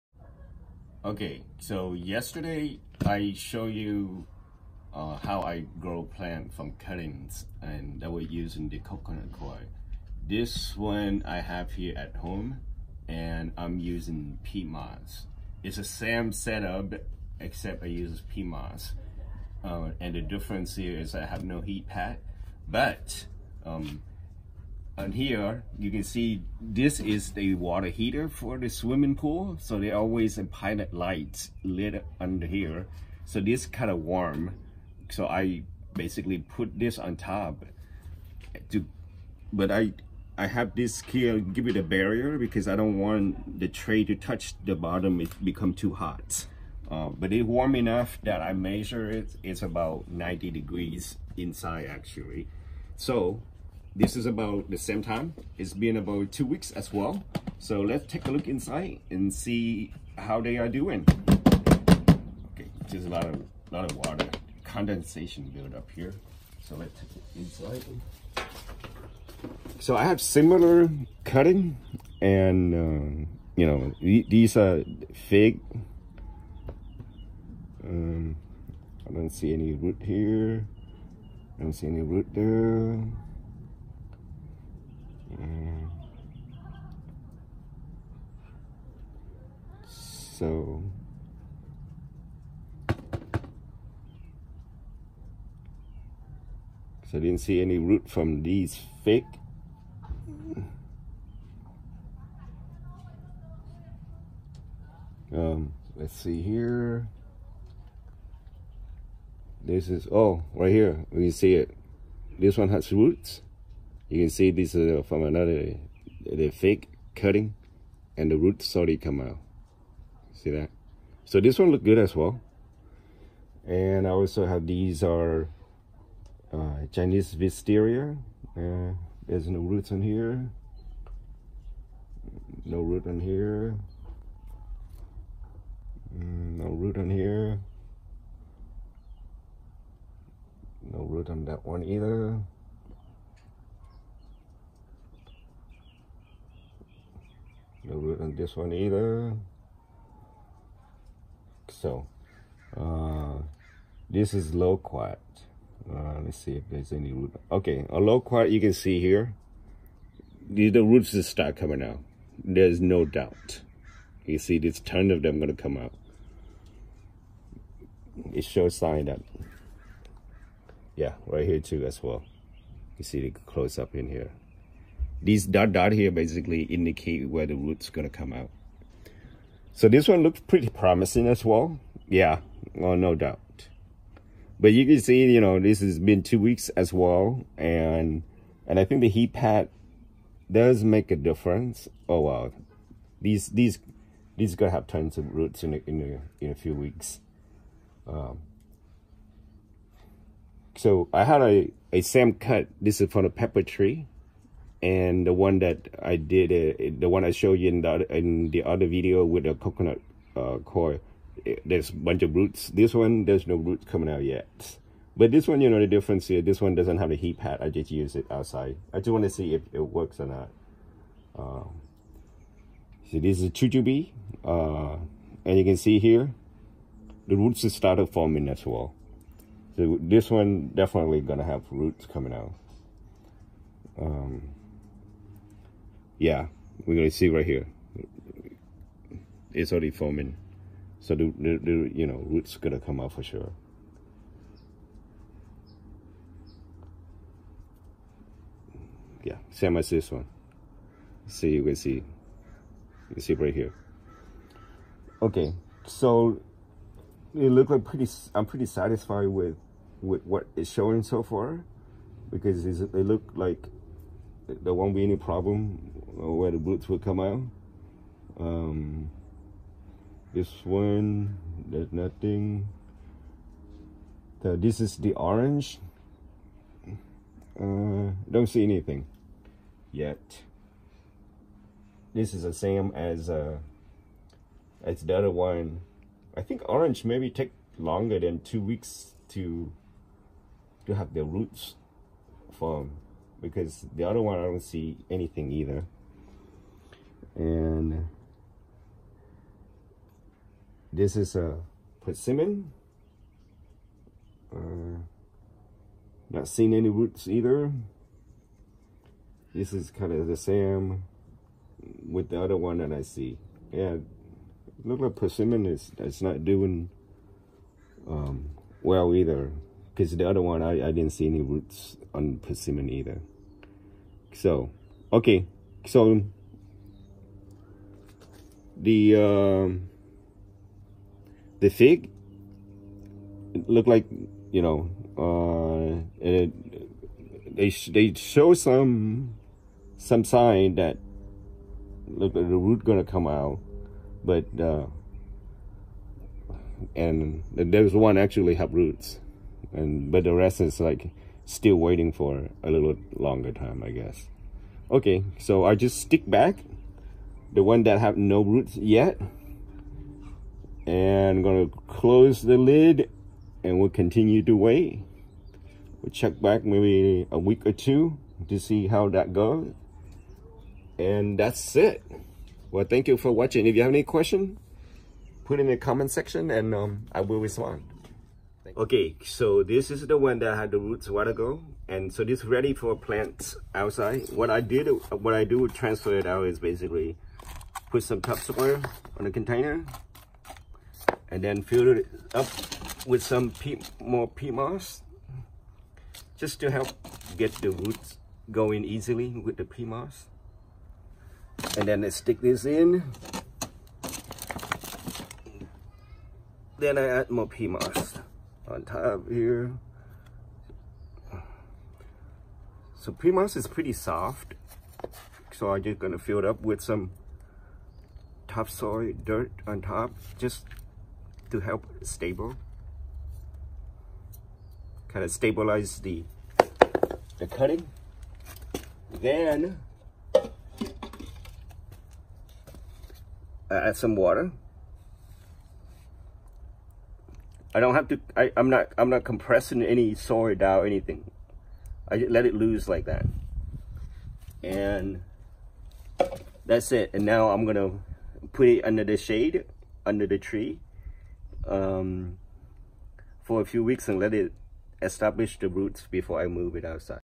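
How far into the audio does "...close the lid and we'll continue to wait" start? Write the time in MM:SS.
06:01.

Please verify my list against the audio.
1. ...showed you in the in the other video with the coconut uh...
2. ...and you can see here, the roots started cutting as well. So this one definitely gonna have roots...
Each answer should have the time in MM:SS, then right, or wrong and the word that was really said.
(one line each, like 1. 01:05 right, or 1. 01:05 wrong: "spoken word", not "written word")
1. 03:27 right
2. 03:45 wrong: "forming", not "cutting".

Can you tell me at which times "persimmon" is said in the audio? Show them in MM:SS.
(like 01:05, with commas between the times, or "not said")
05:02, 05:15, 05:22.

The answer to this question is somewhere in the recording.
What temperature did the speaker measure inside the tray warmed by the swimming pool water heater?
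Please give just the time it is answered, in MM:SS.
00:50.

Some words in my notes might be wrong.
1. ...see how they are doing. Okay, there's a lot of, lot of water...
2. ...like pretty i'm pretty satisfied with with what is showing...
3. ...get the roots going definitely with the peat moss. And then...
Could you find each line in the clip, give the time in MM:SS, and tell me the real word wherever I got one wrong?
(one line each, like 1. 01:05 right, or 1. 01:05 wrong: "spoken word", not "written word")
1. 00:59 right
2. 04:17 right
3. 06:37 wrong: "easily", not "definitely".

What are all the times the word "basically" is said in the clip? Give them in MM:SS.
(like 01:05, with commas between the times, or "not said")
00:35, 02:56, 06:26.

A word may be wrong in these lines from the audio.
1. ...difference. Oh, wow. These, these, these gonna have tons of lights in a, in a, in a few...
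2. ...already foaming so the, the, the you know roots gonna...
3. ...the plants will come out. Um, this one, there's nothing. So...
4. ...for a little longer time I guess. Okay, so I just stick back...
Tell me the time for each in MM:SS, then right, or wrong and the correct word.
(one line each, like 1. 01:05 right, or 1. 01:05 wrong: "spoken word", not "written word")
1. 03:11 wrong: "roots", not "lights"
2. 03:59 right
3. 04:26 wrong: "roots", not "plants"
4. 05:52 right.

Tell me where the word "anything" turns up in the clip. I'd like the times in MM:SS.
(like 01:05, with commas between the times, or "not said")
04:38, 04:55, 07:20.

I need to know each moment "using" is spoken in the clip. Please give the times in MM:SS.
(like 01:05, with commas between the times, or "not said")
00:08, 00:13.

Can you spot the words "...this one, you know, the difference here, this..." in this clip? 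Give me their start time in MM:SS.
03:35.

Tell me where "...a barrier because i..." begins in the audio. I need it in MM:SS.
00:41.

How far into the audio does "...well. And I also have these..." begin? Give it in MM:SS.
02:02.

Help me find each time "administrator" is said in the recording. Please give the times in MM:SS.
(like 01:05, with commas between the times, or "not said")
not said.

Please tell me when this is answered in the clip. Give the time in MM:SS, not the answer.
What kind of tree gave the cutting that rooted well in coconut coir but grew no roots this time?
03:23.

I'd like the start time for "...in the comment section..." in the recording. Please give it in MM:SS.
06:15.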